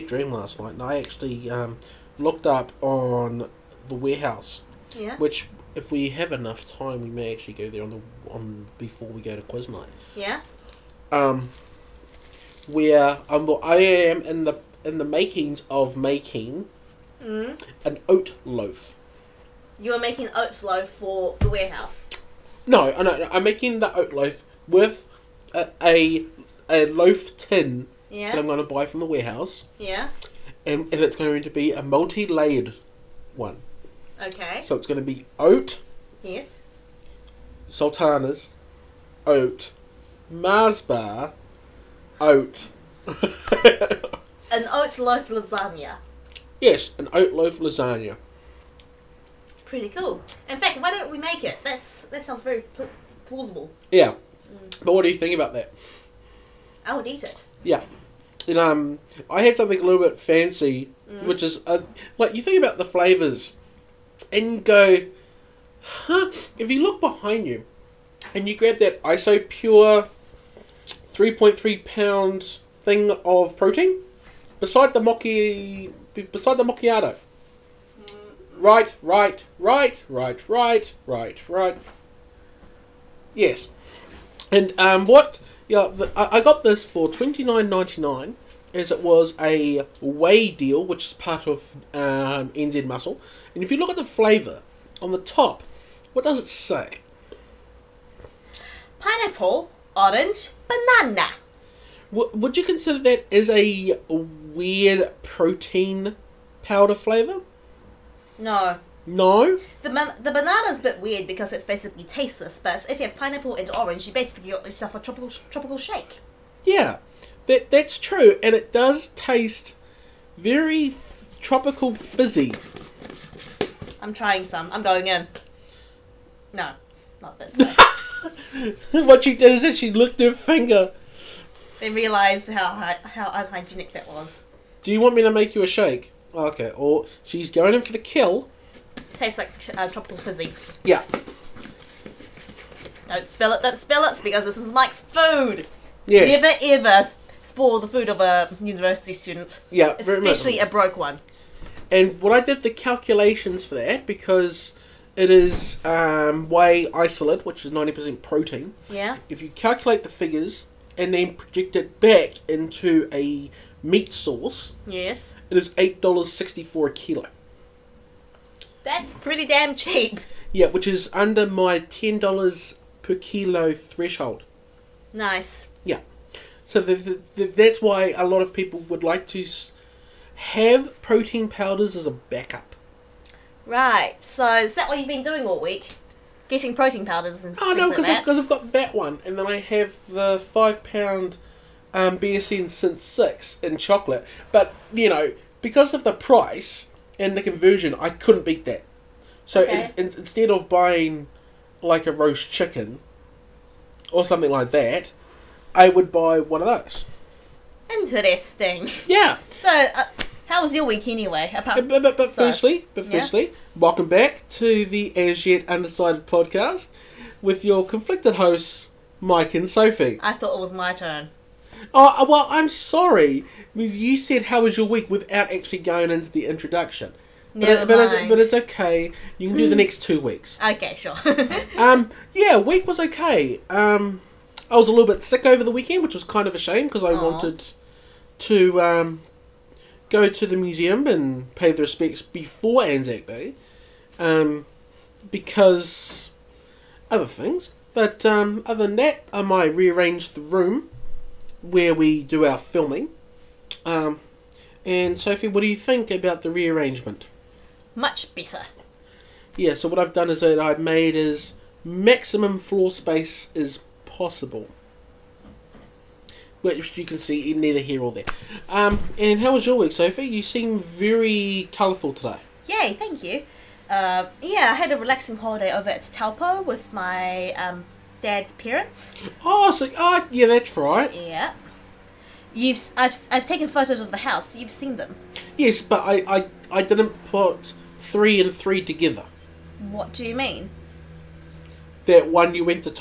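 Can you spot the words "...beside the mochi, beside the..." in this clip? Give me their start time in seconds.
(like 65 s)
74 s.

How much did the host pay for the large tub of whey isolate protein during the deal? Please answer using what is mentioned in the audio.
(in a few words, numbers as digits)
$29.99.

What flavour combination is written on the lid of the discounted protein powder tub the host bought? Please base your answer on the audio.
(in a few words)
Pineapple, orange, banana.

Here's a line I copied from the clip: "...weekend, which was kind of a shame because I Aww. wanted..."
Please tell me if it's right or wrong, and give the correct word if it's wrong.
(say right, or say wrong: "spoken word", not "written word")
right.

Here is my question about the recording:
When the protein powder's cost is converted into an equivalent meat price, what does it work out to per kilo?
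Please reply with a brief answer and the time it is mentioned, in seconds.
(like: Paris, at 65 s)
$8.64, at 165 s.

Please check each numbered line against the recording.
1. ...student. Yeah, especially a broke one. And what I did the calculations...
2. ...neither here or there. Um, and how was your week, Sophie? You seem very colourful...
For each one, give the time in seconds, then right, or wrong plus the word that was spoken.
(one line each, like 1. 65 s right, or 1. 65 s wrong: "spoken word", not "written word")
1. 149 s right
2. 267 s right.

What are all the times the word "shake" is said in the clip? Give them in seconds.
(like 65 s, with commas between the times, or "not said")
115 s, 135 s.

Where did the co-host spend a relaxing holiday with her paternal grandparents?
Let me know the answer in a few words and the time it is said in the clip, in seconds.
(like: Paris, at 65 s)
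Taupo, at 276 s.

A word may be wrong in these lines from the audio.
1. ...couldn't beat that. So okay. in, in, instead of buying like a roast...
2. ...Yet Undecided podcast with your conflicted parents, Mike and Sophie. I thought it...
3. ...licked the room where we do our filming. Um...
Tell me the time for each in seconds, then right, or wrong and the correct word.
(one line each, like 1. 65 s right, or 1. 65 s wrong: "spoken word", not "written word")
1. 198 s right
2. 215 s wrong: "hosts", not "parents"
3. 249 s wrong: "rearranged", not "licked".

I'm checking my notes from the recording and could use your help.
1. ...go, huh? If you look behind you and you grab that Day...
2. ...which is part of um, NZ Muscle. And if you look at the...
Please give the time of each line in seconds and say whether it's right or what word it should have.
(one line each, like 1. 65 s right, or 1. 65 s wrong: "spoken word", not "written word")
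1. 64 s wrong: "Isopure", not "Day"
2. 90 s right.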